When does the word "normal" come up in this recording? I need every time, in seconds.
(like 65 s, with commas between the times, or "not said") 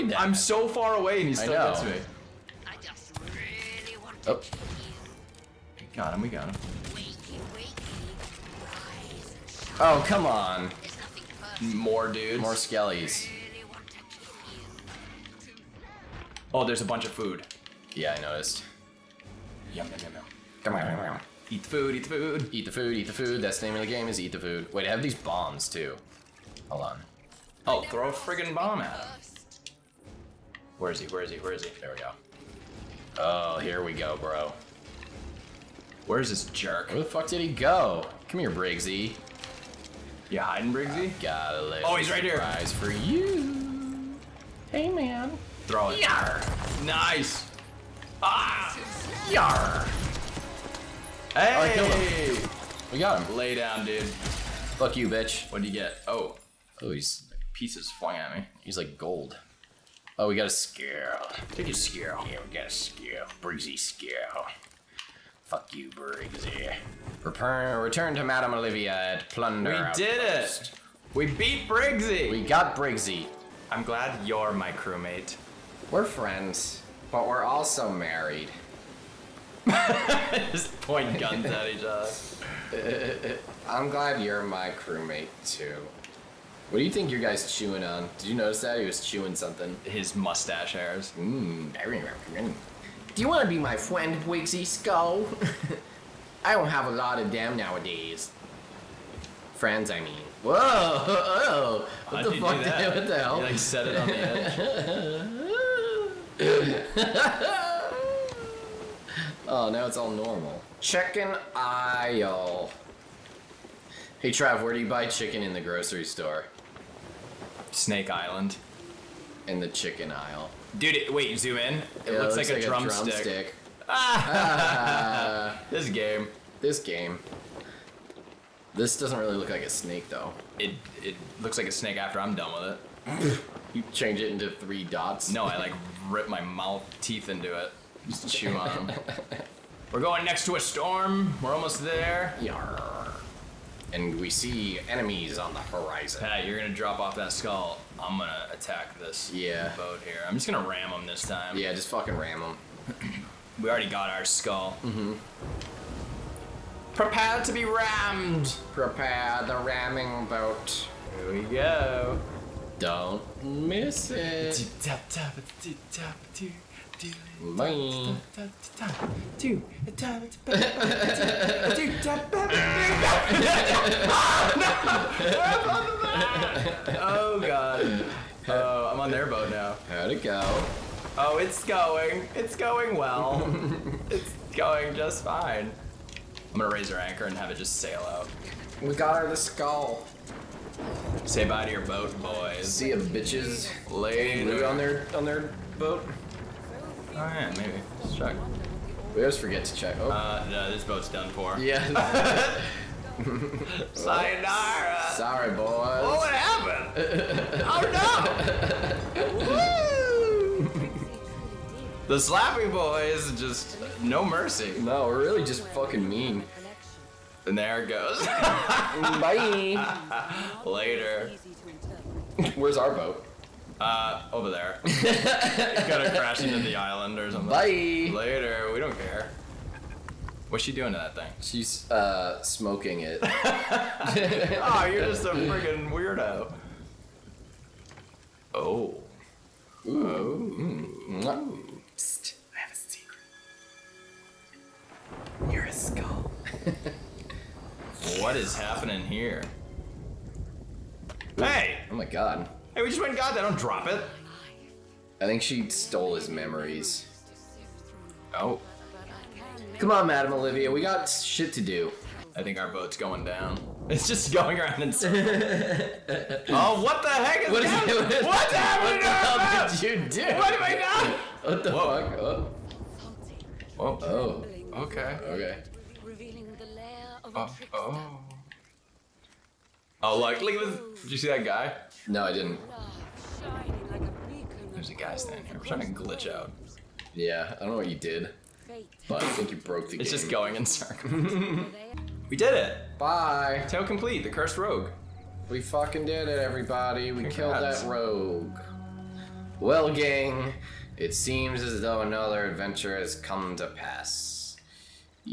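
110 s.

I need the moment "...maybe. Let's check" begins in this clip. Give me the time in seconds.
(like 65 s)
197 s.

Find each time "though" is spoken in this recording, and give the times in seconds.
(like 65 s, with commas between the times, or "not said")
130 s, 301 s.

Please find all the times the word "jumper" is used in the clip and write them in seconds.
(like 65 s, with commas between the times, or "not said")
not said.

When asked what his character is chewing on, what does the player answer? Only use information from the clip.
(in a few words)
His mustache hairs.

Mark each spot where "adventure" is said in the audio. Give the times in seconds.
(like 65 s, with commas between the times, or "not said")
302 s.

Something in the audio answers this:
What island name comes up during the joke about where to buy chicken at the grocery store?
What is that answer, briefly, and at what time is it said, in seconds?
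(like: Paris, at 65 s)
Snake Island, at 117 s.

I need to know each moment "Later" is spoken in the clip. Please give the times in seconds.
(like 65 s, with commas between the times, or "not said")
193 s, 220 s, 228 s.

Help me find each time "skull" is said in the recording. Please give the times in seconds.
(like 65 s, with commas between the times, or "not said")
94 s, 147 s, 154 s, 189 s, 245 s.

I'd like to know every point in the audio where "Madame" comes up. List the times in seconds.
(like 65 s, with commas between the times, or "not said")
68 s, 260 s.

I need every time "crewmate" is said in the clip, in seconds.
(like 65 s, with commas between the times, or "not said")
74 s, 84 s.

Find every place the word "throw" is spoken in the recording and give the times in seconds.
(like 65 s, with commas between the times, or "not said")
27 s, 45 s.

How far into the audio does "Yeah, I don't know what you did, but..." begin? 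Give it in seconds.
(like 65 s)
287 s.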